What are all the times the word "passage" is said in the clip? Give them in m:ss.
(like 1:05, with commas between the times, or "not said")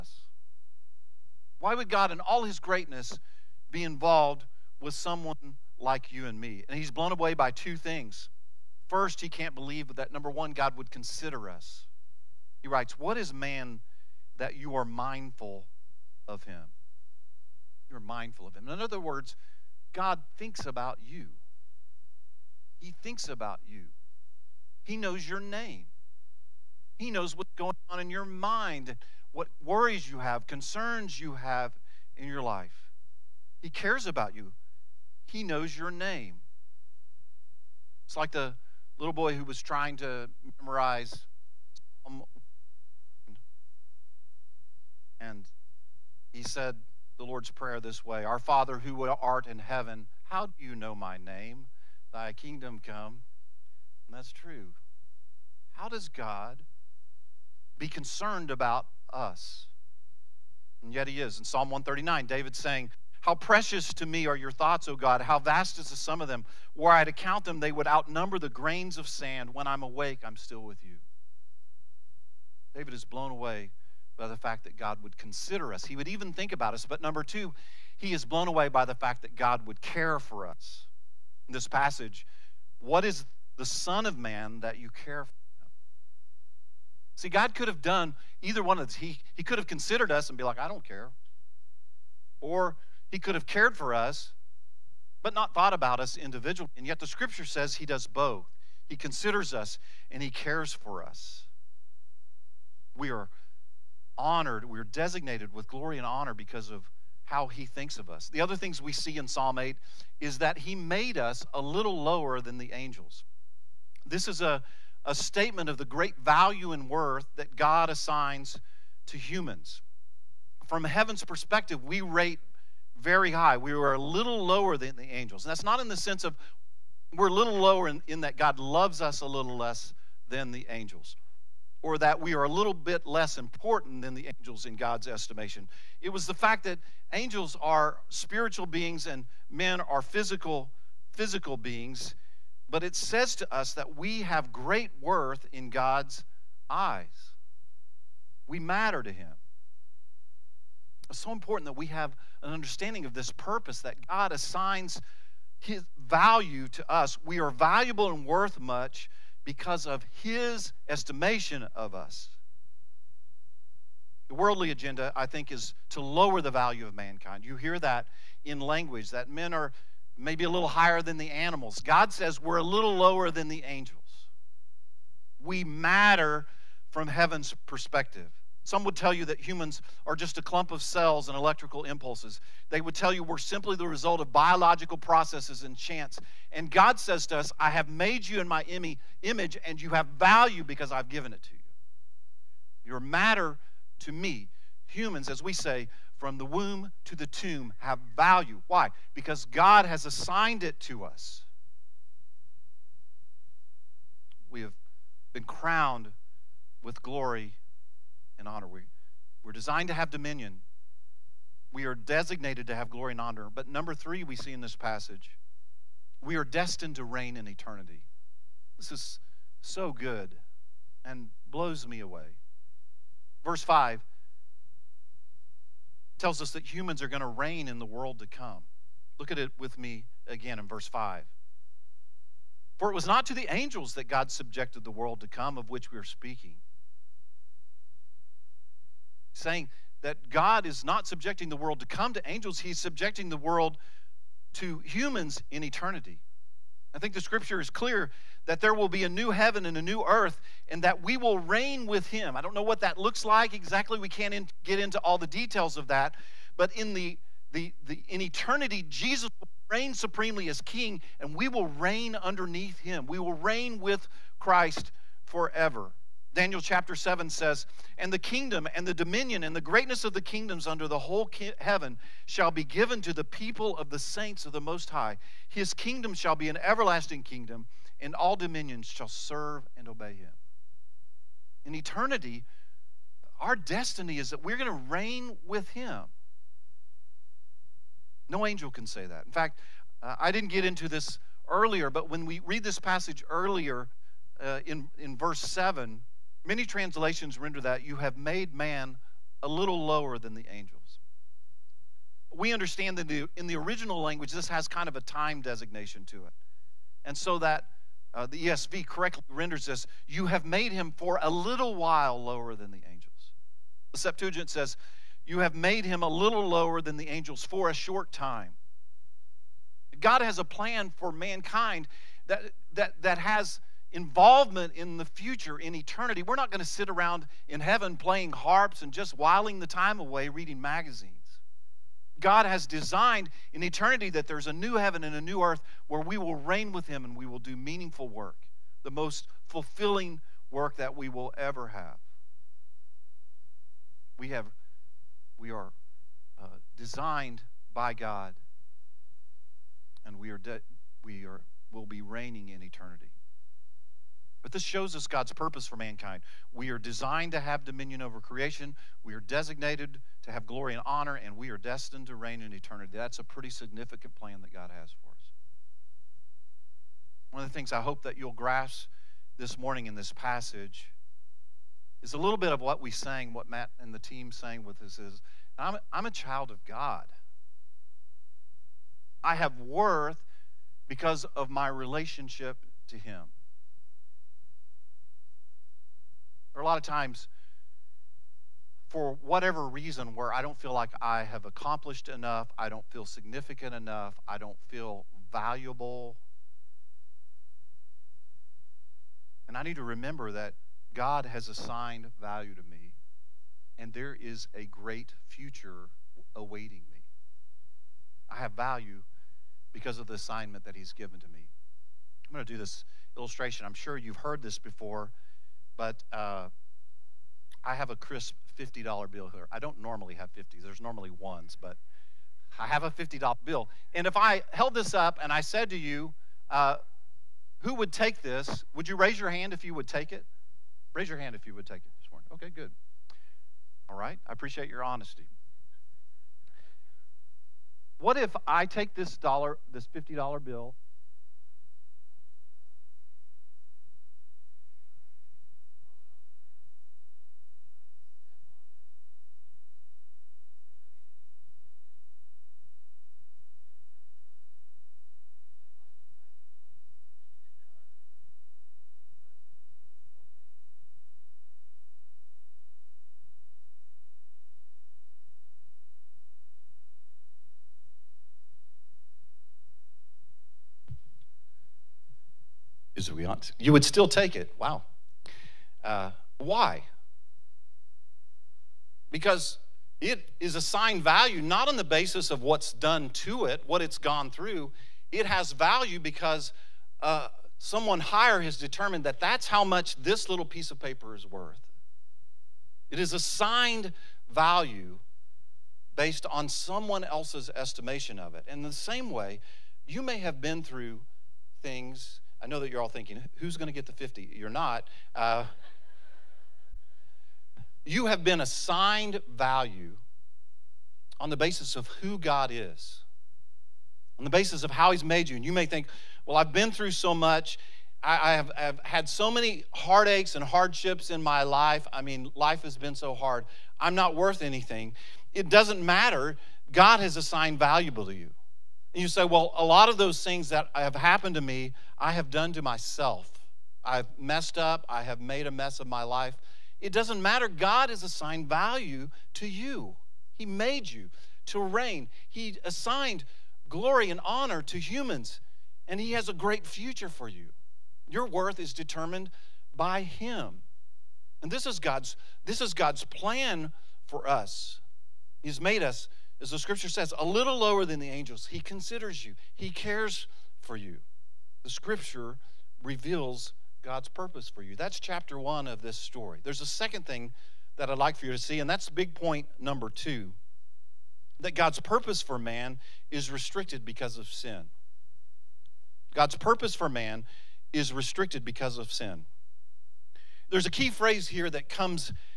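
1:21, 3:34, 4:52, 6:10.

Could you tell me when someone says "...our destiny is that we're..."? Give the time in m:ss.
4:43.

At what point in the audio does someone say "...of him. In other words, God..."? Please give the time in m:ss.
0:18.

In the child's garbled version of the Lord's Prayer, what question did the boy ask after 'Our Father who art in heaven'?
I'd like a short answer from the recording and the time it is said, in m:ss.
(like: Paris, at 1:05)
How do you know my name?, at 0:50.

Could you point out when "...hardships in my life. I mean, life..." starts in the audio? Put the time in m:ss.
8:40.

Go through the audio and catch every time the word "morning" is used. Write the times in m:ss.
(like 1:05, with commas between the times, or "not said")
6:09, 7:12.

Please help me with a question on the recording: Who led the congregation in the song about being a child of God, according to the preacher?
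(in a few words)
Matt and the team.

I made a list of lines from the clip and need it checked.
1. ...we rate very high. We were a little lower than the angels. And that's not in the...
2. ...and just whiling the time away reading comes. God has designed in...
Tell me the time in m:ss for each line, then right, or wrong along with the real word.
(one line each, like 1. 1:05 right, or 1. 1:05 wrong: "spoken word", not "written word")
1. 2:01 right
2. 5:28 wrong: "magazines", not "comes".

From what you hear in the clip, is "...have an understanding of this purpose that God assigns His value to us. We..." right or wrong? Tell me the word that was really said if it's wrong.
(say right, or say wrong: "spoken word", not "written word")
right.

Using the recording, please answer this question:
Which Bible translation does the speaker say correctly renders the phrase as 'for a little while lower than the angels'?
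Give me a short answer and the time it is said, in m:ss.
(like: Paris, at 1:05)
ESV, at 5:08.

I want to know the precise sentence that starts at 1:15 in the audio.
He would even think about us.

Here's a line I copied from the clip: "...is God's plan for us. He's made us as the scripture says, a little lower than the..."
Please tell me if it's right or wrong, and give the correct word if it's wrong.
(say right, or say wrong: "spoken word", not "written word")
right.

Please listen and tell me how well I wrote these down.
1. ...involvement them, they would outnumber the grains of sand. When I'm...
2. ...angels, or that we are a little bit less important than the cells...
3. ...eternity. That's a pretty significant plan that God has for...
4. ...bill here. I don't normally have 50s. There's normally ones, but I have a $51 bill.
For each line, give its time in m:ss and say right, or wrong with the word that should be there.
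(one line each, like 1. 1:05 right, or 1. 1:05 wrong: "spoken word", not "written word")
1. 1:07 wrong: "count", not "involvement"
2. 2:10 wrong: "angels", not "cells"
3. 6:02 right
4. 6:59 wrong: "50", not "51".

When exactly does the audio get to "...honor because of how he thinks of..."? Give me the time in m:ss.
1:46.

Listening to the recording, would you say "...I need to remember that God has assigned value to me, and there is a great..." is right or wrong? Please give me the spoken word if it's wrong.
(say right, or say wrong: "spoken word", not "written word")
right.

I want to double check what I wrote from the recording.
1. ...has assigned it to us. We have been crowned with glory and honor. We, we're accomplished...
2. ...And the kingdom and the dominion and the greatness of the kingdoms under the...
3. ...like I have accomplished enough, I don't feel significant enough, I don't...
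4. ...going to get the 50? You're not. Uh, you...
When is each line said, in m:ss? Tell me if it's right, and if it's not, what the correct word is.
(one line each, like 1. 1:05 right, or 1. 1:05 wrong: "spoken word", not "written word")
1. 3:19 wrong: "designed", not "accomplished"
2. 4:27 right
3. 6:30 right
4. 8:23 right.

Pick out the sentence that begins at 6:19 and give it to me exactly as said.
I have worth because of my relationship to Him.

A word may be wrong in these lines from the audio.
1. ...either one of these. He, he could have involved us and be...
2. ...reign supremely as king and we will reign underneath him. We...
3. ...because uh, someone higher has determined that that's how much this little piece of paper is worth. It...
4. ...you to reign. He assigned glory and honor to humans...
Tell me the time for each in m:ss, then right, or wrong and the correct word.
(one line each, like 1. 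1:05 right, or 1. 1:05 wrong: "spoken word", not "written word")
1. 1:28 wrong: "considered", not "involved"
2. 4:19 right
3. 8:05 right
4. 9:00 right.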